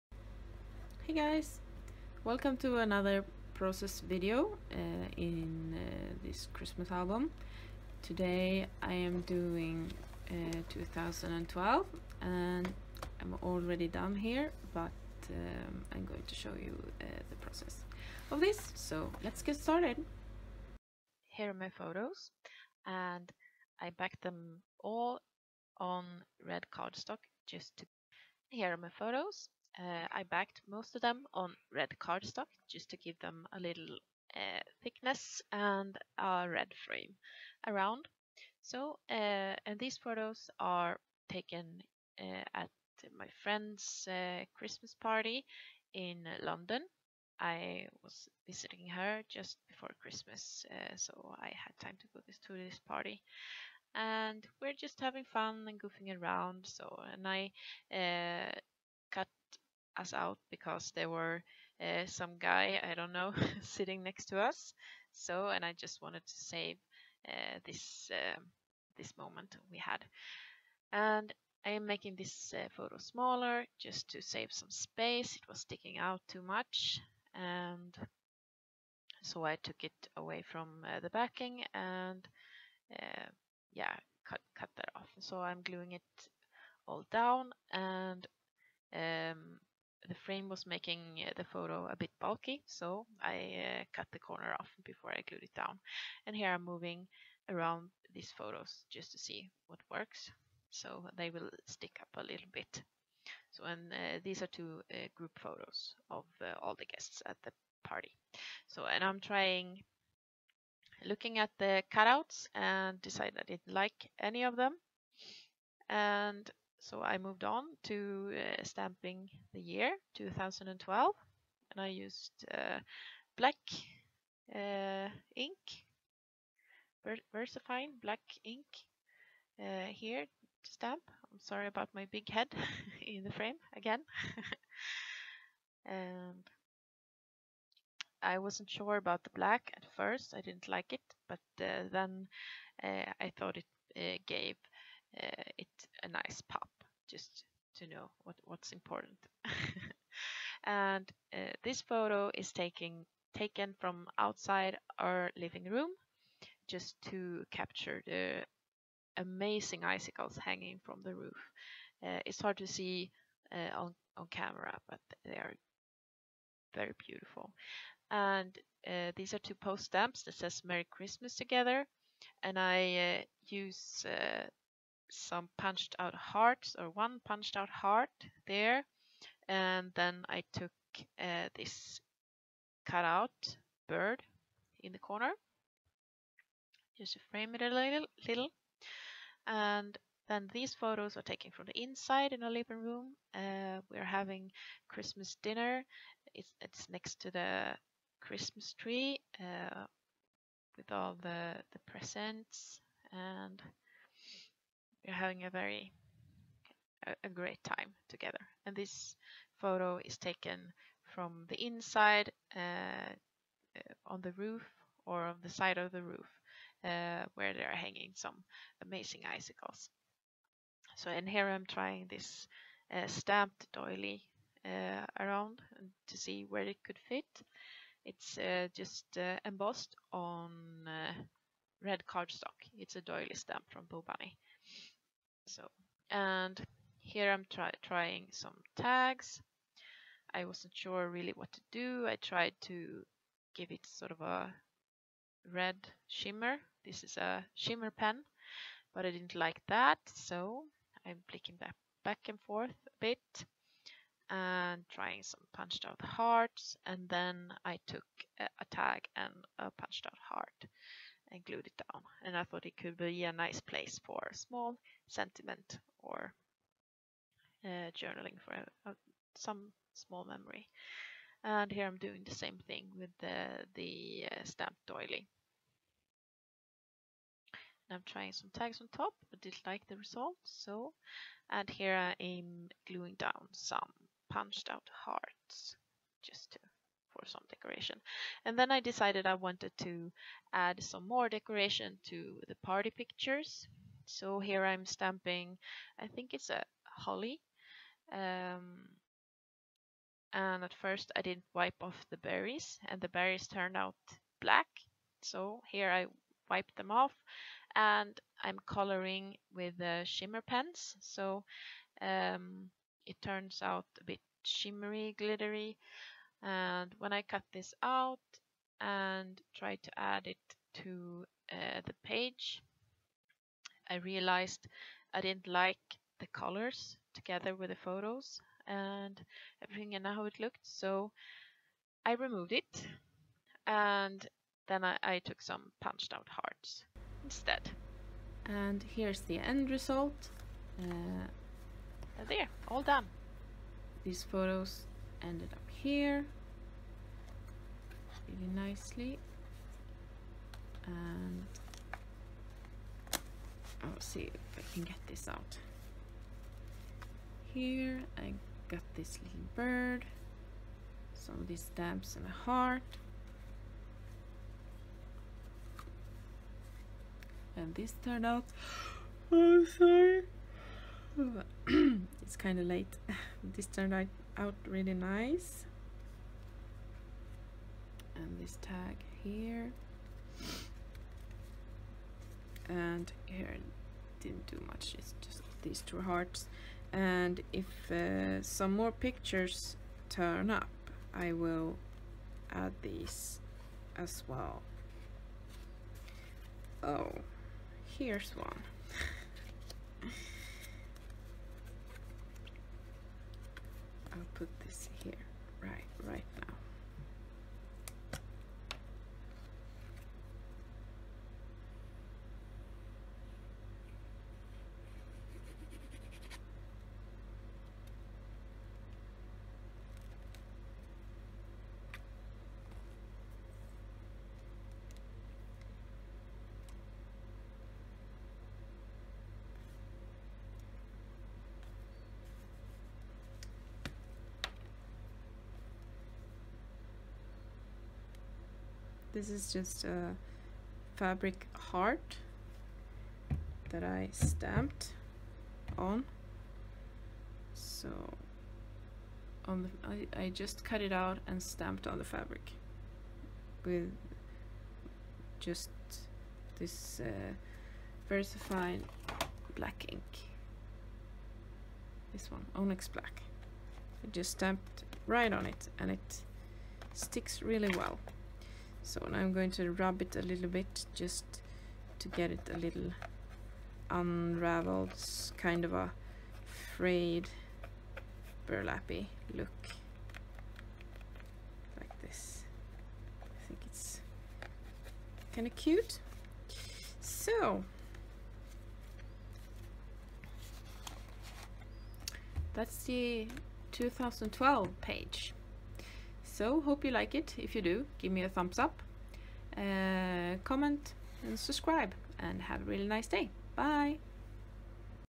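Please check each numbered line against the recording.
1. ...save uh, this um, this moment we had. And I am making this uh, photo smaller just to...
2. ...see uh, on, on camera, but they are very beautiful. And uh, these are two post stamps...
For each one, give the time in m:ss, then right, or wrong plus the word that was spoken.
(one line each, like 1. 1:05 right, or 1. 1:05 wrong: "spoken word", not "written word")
1. 1:06 right
2. 2:42 right.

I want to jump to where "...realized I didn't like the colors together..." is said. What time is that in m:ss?
5:23.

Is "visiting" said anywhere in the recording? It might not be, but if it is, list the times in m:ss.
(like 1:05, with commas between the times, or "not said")
0:48.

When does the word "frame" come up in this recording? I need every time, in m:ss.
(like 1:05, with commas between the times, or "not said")
0:36, 1:30, 2:13, 3:07.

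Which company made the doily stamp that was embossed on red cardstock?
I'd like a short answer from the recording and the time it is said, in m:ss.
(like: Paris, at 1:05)
Bo Bunny, at 3:53.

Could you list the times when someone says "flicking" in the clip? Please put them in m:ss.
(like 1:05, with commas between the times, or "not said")
4:11.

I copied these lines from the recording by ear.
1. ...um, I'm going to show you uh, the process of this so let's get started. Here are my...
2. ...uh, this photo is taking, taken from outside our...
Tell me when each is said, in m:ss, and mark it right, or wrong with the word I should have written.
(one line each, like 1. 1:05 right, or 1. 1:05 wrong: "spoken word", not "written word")
1. 0:15 right
2. 2:31 right.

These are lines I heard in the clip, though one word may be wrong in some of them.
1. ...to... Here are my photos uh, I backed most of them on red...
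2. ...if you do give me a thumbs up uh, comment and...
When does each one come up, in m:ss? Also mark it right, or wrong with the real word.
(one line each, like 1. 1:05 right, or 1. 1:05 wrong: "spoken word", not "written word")
1. 0:27 right
2. 8:17 right.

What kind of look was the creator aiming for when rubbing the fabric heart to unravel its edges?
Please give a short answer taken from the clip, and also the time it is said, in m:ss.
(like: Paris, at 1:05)
Frayed burlappy look, at 7:56.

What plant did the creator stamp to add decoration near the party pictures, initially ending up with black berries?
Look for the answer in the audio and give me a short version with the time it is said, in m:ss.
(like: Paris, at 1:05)
Holly, at 4:56.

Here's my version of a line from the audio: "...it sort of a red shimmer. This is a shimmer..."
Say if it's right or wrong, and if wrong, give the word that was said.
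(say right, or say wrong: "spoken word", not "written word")
right.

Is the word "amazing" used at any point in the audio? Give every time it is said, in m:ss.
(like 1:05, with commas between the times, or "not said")
2:39, 3:38.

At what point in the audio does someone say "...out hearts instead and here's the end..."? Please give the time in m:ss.
5:36.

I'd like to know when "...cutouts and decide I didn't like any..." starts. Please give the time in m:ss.
1:51.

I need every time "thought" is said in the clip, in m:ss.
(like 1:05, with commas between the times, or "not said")
2:23, 4:22.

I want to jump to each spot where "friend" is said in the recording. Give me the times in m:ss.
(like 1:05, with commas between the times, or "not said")
0:43.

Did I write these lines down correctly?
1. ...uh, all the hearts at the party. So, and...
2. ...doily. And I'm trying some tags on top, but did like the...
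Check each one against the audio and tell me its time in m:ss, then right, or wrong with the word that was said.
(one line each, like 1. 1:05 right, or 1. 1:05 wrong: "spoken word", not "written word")
1. 1:46 wrong: "guests", not "hearts"
2. 4:34 right.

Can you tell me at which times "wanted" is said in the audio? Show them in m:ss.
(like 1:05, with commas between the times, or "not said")
1:06, 4:49.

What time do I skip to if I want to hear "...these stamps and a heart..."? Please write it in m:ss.
6:01.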